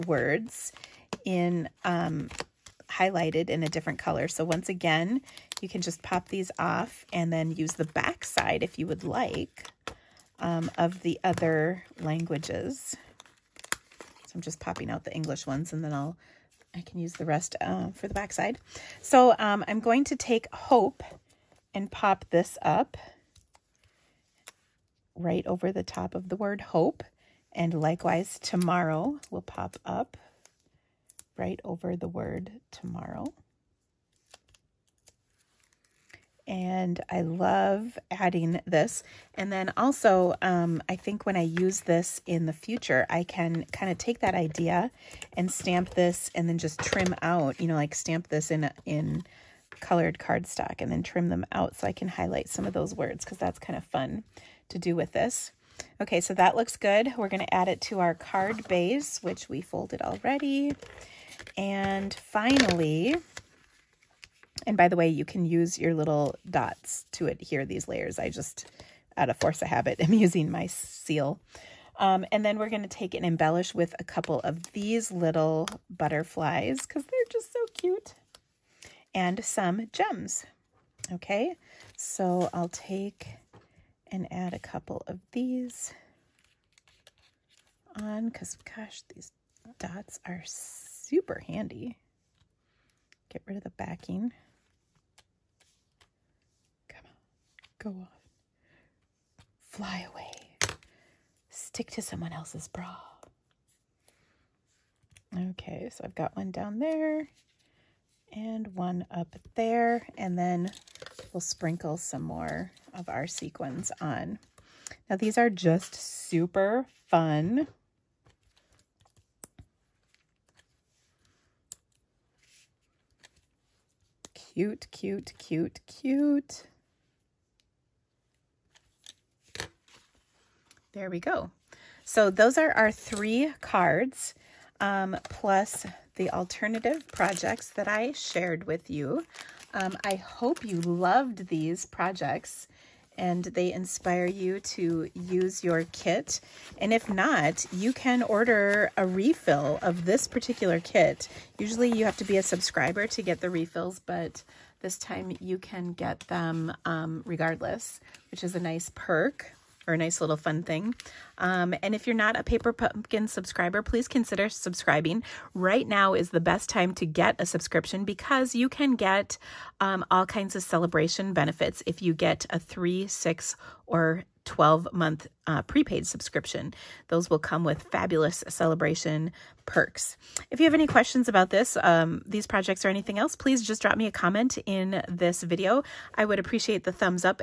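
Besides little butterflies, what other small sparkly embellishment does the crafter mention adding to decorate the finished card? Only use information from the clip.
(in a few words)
Gems.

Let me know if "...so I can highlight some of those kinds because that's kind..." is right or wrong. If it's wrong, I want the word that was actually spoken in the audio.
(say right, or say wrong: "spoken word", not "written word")
wrong: "words", not "kinds".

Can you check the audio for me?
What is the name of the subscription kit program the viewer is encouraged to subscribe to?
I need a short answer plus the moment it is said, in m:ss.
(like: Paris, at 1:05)
Paper Pumpkin, at 2:42.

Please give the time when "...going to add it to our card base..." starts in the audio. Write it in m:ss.
0:57.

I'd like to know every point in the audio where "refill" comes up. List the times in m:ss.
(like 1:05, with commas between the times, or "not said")
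2:29, 2:33.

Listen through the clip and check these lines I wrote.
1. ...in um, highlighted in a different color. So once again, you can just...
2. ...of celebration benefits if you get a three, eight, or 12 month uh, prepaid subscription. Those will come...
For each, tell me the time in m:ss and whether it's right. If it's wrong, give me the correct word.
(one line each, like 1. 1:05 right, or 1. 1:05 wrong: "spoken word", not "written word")
1. 0:01 right
2. 2:50 wrong: "six", not "eight".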